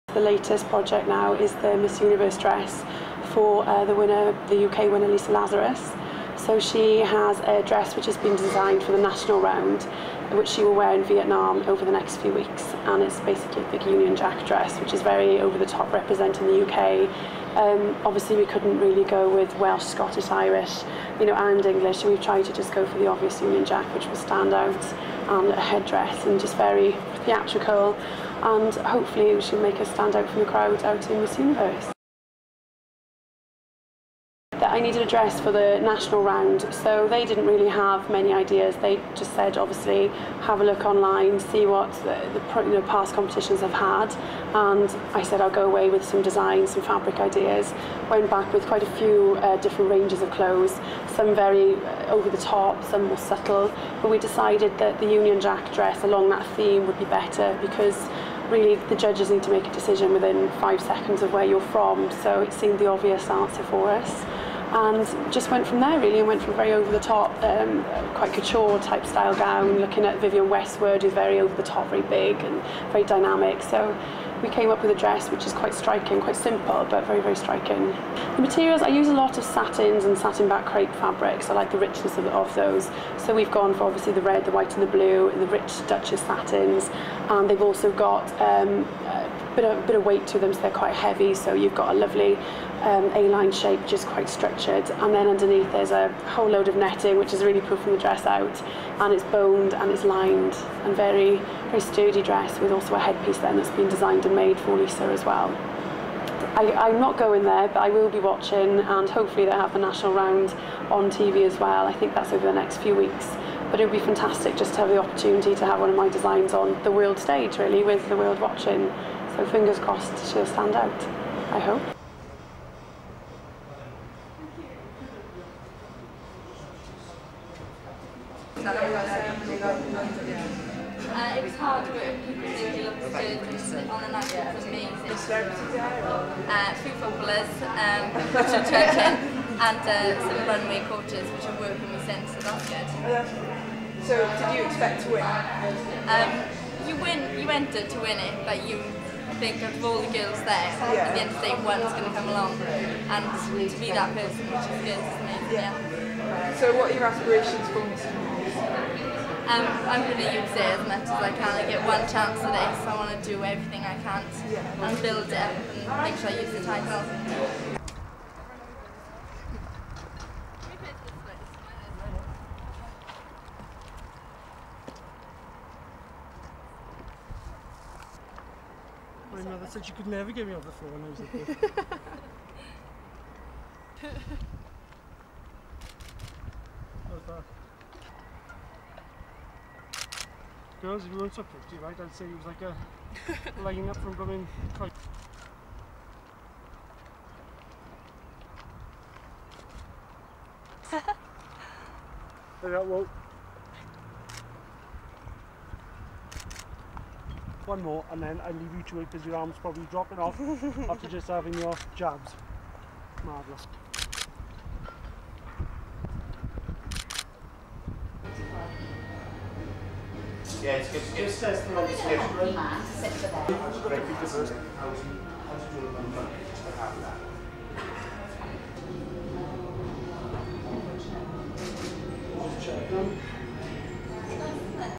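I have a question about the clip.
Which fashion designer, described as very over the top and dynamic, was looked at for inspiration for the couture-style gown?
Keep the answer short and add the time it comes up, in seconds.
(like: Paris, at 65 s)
Vivienne Westwood, at 70 s.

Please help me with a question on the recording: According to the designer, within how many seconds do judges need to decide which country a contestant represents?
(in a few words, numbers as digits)
5.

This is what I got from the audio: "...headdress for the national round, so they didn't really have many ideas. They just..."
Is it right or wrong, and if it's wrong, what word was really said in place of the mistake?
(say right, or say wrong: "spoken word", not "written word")
wrong: "dress", not "headdress".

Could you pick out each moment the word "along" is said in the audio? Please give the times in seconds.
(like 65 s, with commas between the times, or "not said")
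56 s, 152 s.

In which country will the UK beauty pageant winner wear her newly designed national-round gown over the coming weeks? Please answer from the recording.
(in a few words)
Vietnam.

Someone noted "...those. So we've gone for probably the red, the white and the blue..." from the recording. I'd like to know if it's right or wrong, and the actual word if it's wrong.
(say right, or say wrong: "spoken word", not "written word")
wrong: "obviously", not "probably".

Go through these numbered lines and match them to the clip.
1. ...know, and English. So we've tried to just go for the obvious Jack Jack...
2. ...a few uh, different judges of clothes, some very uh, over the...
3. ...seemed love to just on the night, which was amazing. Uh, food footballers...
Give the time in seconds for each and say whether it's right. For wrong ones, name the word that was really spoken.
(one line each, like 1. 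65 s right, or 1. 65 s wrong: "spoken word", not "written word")
1. 21 s wrong: "Union", not "Jack"
2. 48 s wrong: "ranges", not "judges"
3. 132 s right.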